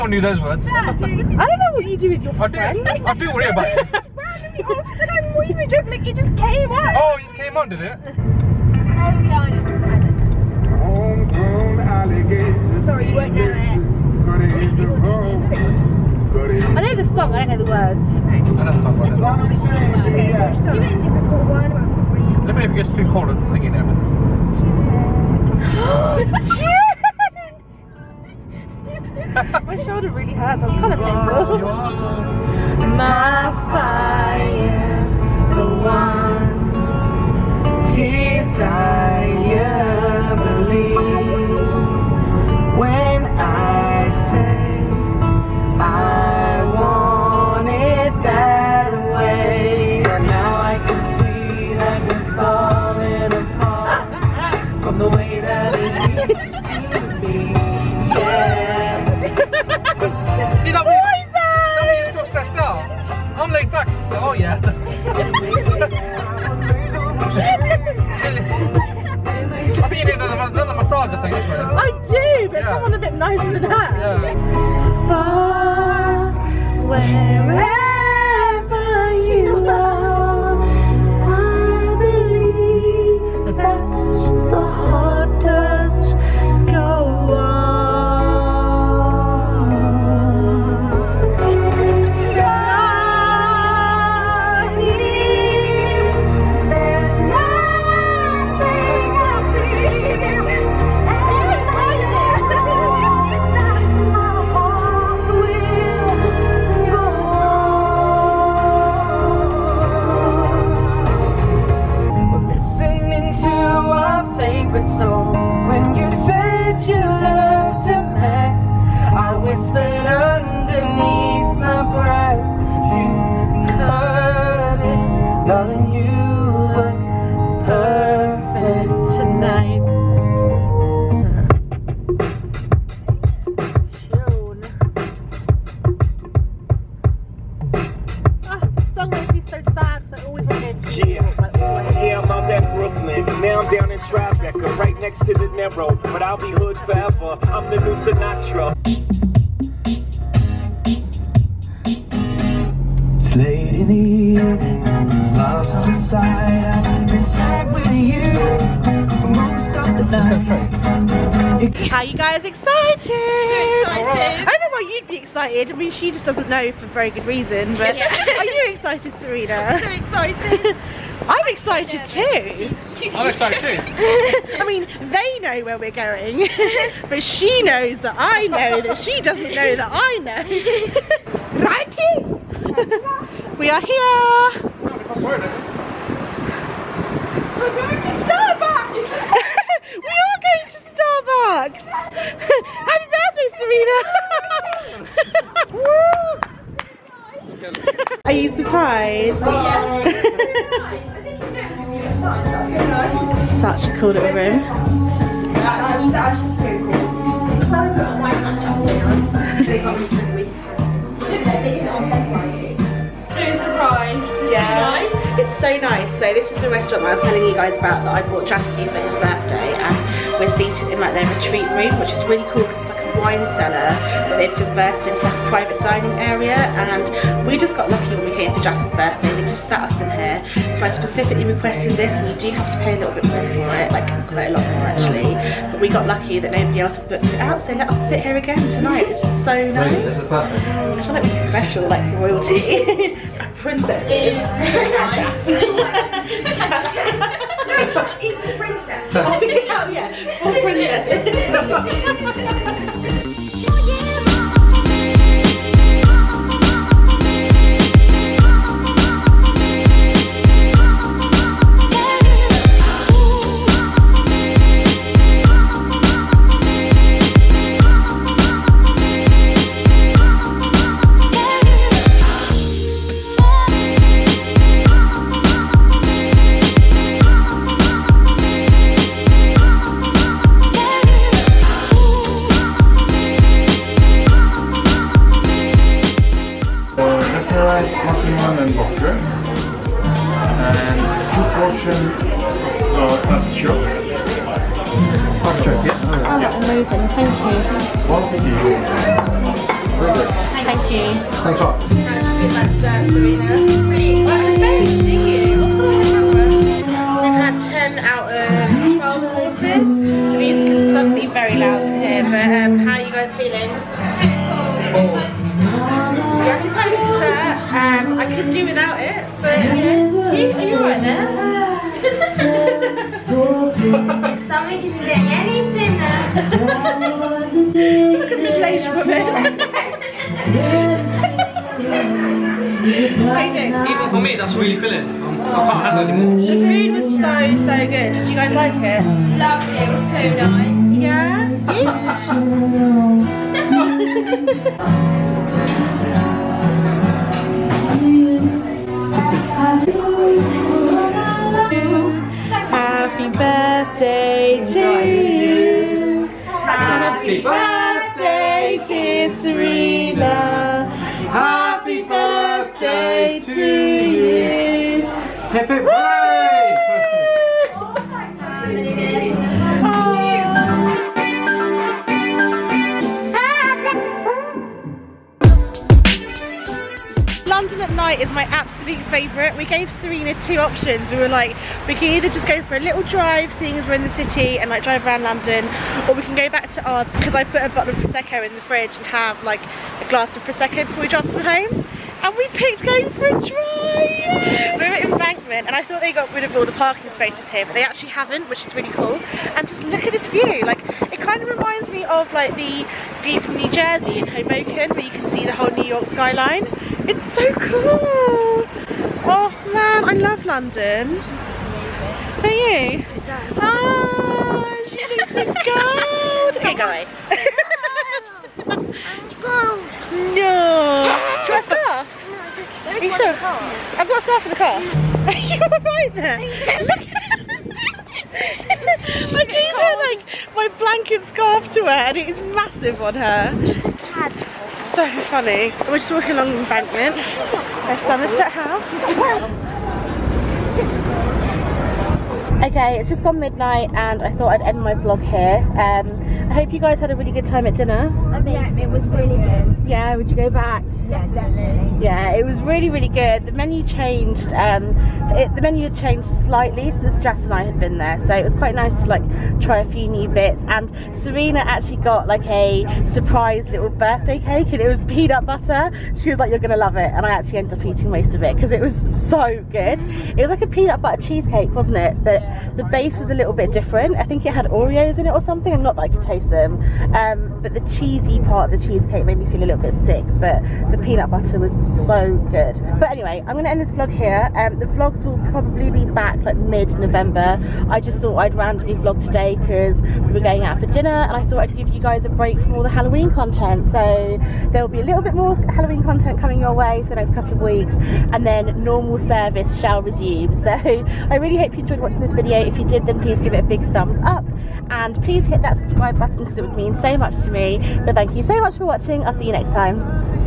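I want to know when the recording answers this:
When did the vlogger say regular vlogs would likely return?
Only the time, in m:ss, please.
8:06.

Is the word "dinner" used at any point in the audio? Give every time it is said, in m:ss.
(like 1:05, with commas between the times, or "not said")
7:27, 8:10.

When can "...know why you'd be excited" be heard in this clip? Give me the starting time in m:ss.
2:44.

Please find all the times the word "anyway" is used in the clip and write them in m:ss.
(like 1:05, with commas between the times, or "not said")
8:03.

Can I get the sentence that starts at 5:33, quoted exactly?
Even for me, that's really filling.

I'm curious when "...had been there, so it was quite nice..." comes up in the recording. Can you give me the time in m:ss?
7:37.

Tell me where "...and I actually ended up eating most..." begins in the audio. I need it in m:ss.
7:47.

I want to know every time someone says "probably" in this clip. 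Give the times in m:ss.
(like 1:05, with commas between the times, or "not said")
8:05.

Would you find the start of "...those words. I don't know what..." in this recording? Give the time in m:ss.
0:00.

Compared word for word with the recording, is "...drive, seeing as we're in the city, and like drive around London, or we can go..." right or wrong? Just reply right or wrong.
right.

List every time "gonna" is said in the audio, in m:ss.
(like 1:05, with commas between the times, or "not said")
7:46, 8:03.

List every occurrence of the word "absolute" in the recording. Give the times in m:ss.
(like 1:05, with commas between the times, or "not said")
6:18.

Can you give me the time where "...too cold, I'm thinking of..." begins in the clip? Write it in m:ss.
0:22.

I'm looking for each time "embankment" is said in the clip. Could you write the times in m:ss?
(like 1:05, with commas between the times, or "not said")
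6:35, 7:16.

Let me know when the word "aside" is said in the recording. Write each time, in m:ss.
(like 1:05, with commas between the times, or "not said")
not said.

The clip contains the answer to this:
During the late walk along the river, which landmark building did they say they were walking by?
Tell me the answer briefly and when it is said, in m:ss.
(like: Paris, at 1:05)
Somerset House, at 7:17.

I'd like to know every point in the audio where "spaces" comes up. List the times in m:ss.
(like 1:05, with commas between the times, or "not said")
6:37.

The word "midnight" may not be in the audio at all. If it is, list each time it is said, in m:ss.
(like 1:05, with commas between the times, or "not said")
7:23.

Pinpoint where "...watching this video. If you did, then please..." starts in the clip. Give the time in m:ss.
8:21.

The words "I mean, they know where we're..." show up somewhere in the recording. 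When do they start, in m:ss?
2:54.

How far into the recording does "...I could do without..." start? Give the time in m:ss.
5:18.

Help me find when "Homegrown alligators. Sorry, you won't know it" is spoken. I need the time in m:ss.
0:10.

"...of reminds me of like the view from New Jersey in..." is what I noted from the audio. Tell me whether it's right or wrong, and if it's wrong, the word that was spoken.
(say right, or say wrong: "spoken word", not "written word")
right.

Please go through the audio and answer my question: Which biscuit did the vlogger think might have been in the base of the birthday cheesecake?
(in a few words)
Oreos.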